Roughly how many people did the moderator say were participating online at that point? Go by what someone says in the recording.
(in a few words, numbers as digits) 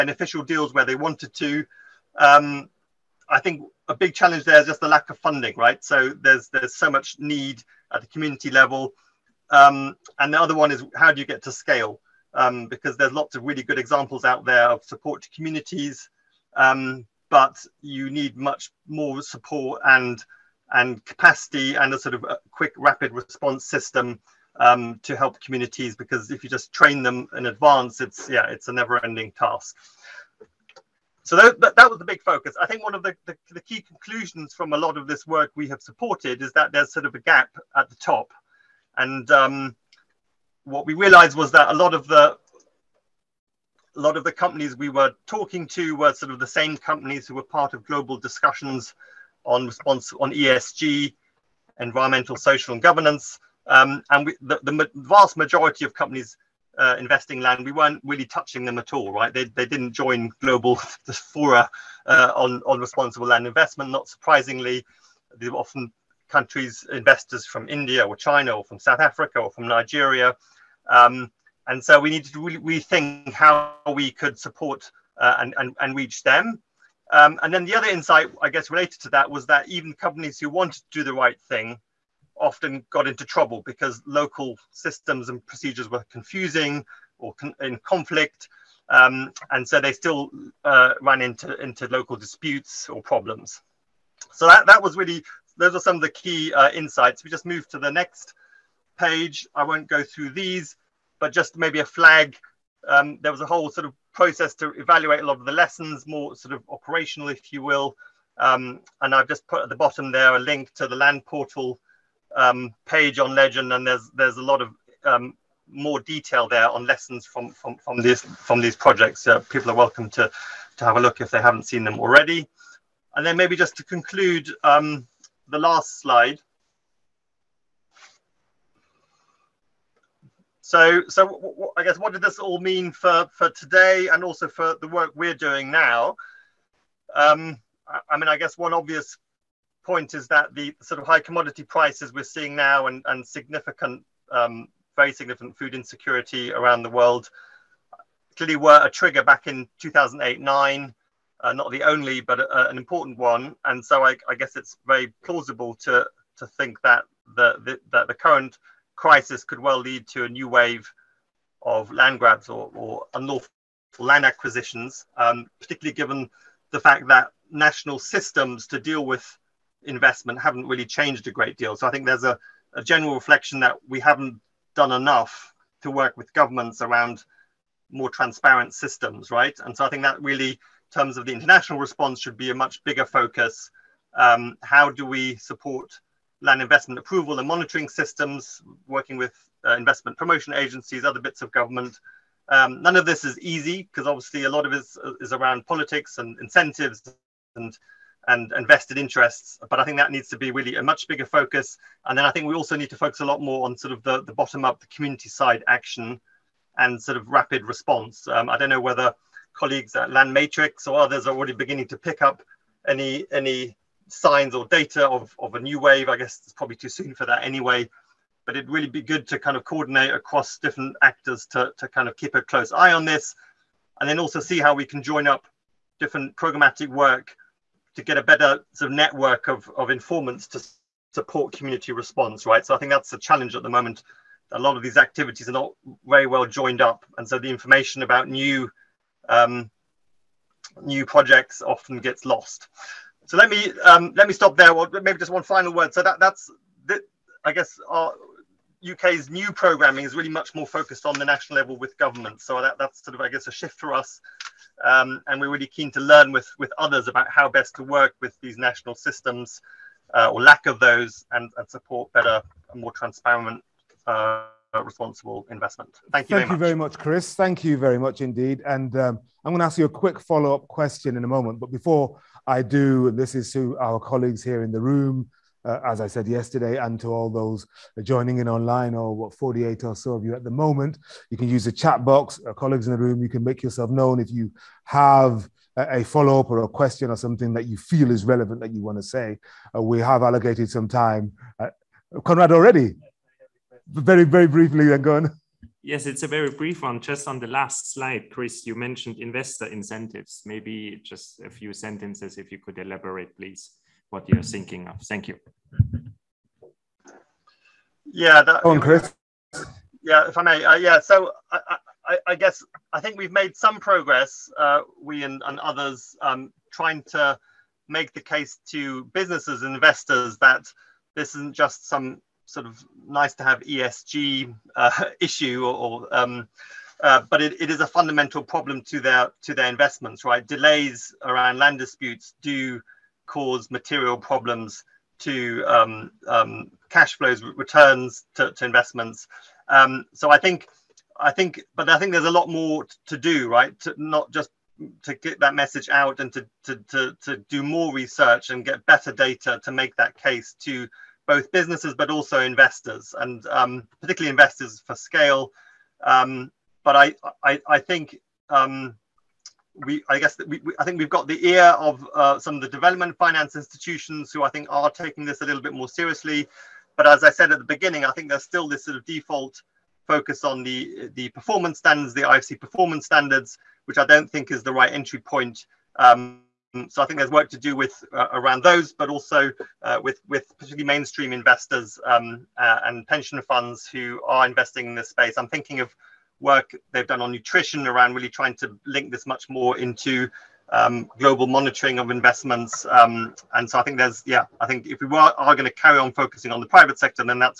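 48.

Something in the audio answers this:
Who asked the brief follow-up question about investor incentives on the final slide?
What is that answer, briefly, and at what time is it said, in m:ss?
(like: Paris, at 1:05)
Conrad, at 4:52.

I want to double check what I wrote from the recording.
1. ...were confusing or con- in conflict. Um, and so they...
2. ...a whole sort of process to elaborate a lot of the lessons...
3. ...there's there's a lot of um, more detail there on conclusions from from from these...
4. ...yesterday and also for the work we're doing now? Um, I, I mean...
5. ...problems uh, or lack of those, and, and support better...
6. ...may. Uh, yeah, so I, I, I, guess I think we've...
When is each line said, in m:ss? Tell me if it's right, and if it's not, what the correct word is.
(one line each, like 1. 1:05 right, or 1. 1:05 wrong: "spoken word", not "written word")
1. 1:25 right
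2. 1:43 wrong: "evaluate", not "elaborate"
3. 1:53 wrong: "lessons", not "conclusions"
4. 2:13 wrong: "today", not "yesterday"
5. 4:18 wrong: "systems", not "problems"
6. 5:10 right.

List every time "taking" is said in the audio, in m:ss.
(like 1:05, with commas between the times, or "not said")
6:04.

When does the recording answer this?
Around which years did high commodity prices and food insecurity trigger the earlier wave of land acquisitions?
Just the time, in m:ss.
2:29.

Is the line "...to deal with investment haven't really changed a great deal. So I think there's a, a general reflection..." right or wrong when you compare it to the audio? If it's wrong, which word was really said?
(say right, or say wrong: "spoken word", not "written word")
right.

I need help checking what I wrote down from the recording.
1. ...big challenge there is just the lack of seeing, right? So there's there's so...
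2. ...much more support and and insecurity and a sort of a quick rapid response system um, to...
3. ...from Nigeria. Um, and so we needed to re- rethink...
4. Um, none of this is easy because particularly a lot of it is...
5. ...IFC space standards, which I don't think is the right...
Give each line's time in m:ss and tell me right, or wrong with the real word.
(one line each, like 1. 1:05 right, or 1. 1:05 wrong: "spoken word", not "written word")
1. 0:03 wrong: "funding", not "seeing"
2. 0:18 wrong: "capacity", not "insecurity"
3. 1:09 right
4. 3:12 wrong: "obviously", not "particularly"
5. 6:12 wrong: "performance", not "space".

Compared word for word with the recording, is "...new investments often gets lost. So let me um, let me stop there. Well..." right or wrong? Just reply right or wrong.
wrong.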